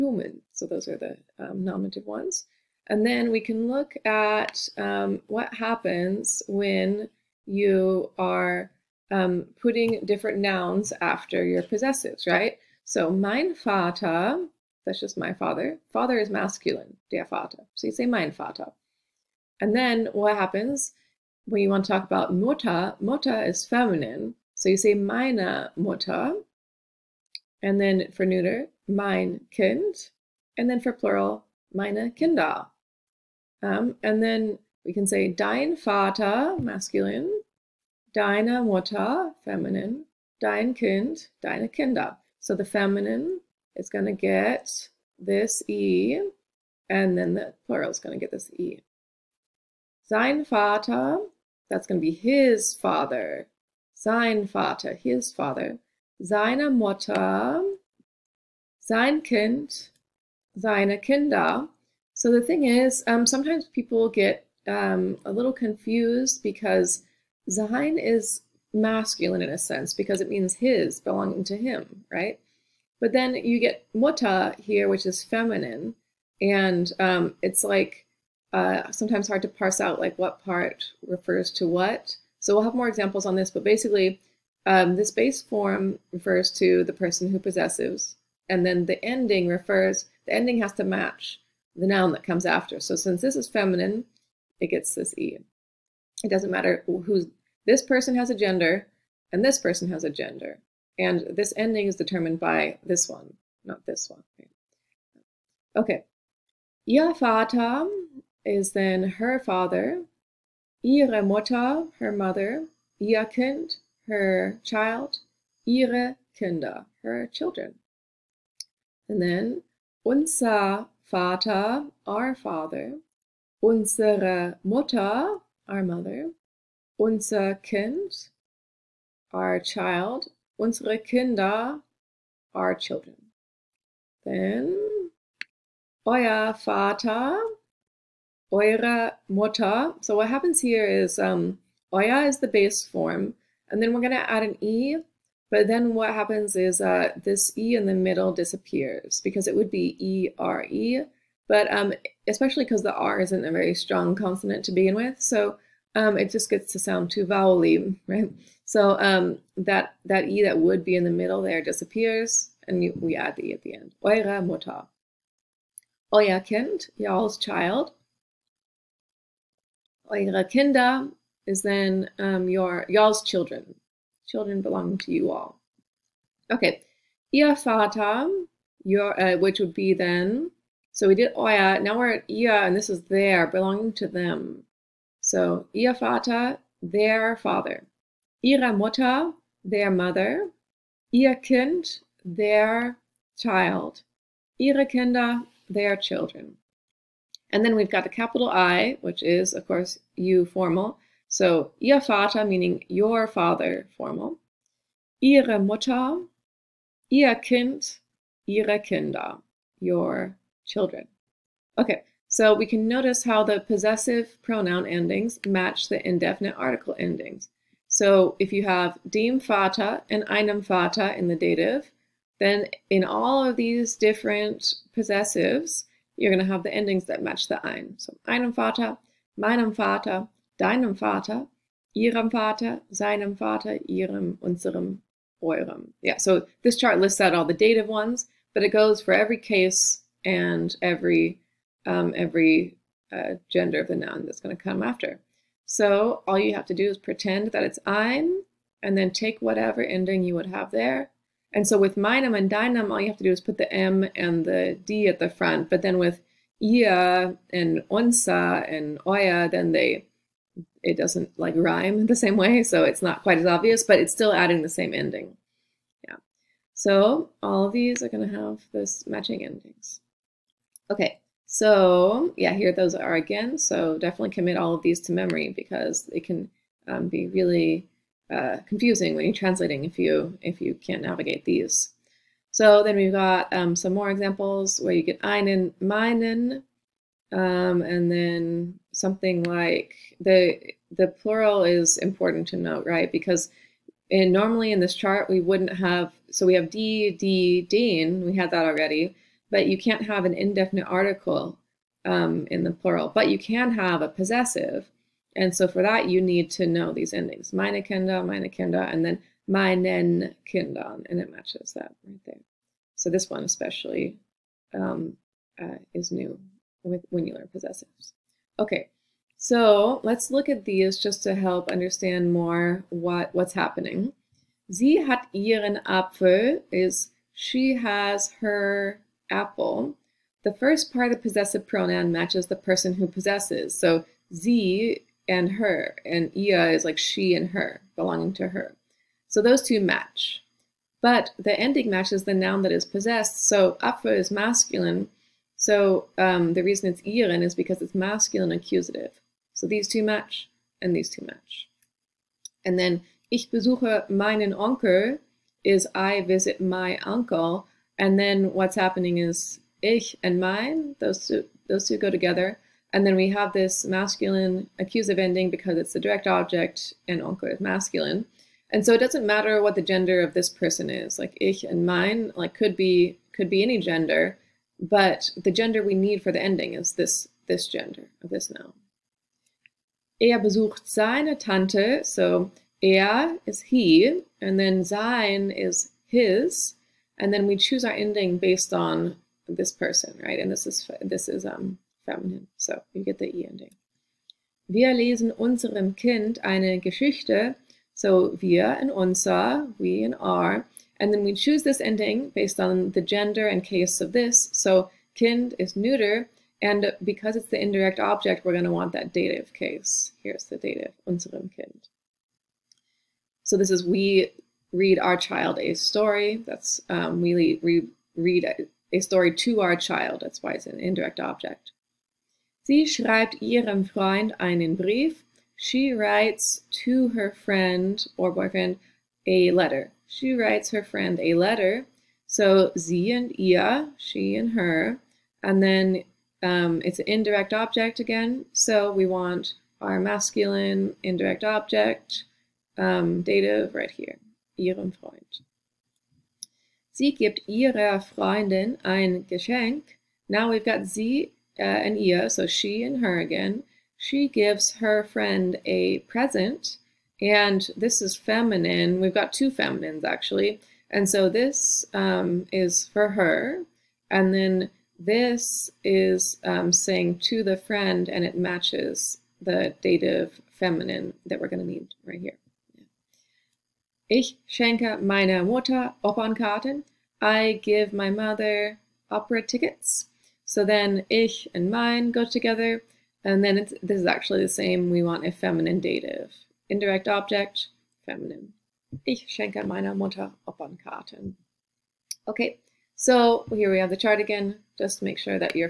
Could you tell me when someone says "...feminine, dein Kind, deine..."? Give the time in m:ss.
0:39.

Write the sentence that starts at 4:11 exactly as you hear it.
And so with meinem and deinem, all you have to do is put the M and the D at the front.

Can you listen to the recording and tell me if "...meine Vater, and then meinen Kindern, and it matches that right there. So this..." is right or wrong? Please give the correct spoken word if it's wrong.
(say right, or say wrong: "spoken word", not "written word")
wrong: "Kinder", not "Vater".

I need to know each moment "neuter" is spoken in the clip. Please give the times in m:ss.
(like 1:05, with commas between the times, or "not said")
0:28, 6:45.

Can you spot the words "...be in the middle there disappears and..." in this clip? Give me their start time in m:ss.
2:40.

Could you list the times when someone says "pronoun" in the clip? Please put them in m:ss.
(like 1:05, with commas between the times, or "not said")
3:34, 5:31.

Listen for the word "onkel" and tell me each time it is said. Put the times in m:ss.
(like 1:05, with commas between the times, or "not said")
5:54, 6:07.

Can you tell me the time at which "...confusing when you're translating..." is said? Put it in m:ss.
4:38.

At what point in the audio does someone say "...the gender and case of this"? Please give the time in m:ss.
6:42.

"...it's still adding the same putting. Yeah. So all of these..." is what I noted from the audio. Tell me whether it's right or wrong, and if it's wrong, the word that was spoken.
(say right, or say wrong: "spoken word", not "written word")
wrong: "ending", not "putting".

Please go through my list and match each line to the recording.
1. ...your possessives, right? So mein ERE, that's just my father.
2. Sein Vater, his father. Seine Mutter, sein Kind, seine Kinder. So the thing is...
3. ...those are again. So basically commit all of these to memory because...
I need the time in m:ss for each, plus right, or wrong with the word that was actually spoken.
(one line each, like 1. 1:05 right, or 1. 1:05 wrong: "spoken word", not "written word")
1. 0:11 wrong: "Vater", not "ERE"
2. 0:53 right
3. 4:32 wrong: "definitely", not "basically".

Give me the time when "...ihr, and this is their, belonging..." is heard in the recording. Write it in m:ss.
3:02.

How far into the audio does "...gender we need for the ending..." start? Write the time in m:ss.
6:15.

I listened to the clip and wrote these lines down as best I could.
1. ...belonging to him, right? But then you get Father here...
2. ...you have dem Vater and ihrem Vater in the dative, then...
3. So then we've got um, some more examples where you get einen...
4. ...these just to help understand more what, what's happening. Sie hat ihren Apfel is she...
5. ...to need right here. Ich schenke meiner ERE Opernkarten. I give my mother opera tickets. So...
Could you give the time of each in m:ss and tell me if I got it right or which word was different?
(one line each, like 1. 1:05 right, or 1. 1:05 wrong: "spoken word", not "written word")
1. 1:10 wrong: "Mutter", not "Father"
2. 3:38 wrong: "einem", not "ihrem"
3. 4:42 right
4. 5:20 right
5. 7:51 wrong: "Mutter", not "ERE".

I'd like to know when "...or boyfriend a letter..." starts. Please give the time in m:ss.
7:08.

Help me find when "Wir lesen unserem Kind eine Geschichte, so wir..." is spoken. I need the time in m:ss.
6:34.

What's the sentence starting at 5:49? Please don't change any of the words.
So these two match and these two match.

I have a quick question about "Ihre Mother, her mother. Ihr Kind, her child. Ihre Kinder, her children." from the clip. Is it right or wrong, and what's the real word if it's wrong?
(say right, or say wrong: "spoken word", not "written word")
wrong: "Mutter", not "Mother".